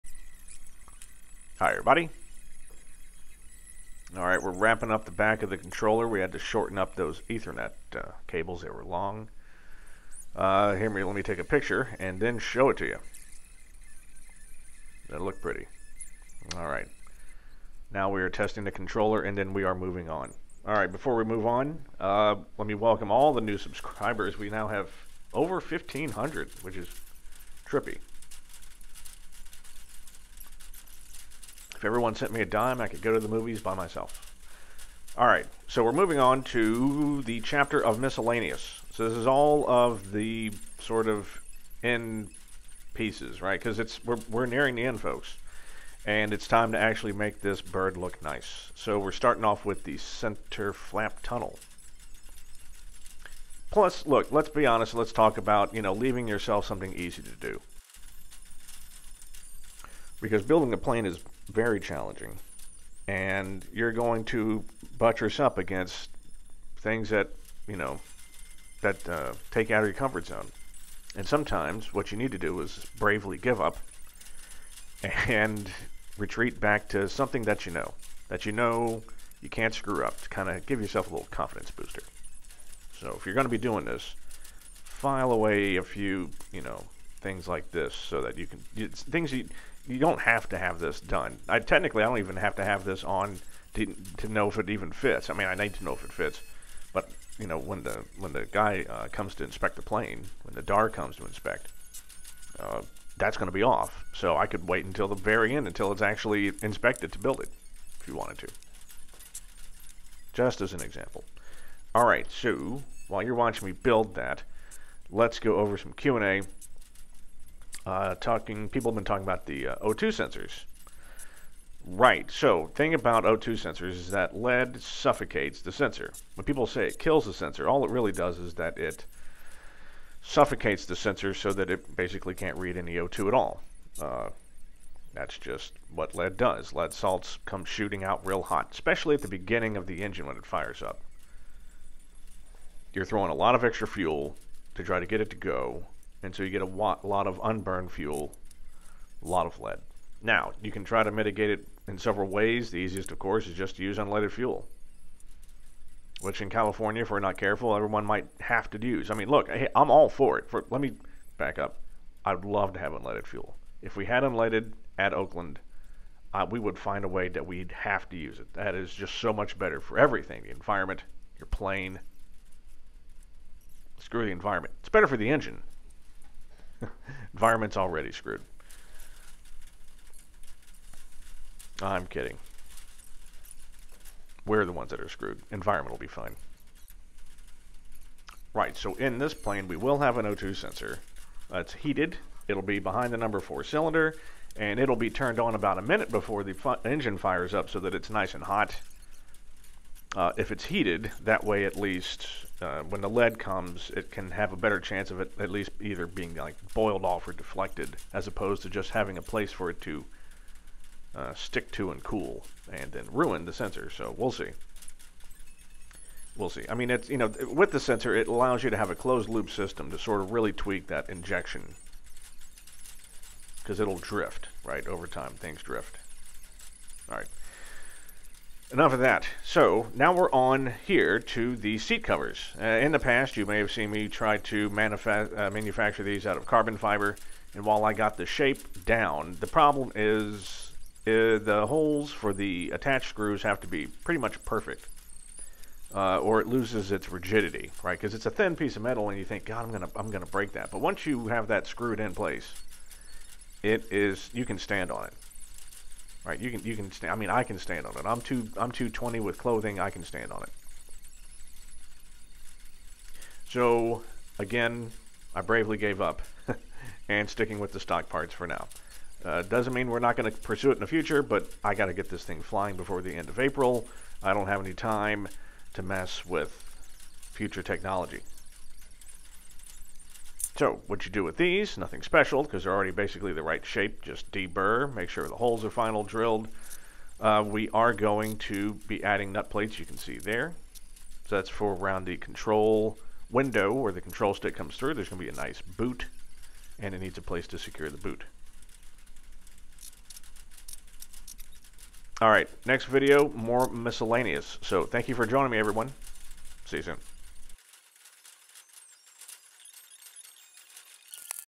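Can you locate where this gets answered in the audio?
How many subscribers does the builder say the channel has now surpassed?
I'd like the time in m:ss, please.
0:25.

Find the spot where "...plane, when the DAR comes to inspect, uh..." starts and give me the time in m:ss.
1:39.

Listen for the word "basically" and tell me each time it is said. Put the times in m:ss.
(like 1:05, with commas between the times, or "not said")
2:11, 4:42.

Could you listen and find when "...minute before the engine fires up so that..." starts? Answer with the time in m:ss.
3:15.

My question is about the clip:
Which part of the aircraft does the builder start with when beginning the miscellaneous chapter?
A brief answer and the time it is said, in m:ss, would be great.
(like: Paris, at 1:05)
center flap tunnel, at 0:49.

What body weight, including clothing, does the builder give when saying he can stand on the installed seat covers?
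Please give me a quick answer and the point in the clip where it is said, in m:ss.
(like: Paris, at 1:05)
220, at 4:18.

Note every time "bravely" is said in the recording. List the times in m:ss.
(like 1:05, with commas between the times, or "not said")
1:12, 4:25.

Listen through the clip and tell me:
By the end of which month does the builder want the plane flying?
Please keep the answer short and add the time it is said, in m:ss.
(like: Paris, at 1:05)
April, at 4:33.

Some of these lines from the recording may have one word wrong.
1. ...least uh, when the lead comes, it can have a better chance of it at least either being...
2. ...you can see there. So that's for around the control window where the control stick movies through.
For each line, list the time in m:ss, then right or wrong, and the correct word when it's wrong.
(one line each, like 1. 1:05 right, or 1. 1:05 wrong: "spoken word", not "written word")
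1. 3:21 right
2. 4:49 wrong: "comes", not "movies".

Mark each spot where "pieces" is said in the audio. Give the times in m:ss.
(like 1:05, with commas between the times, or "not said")
0:42, 4:08.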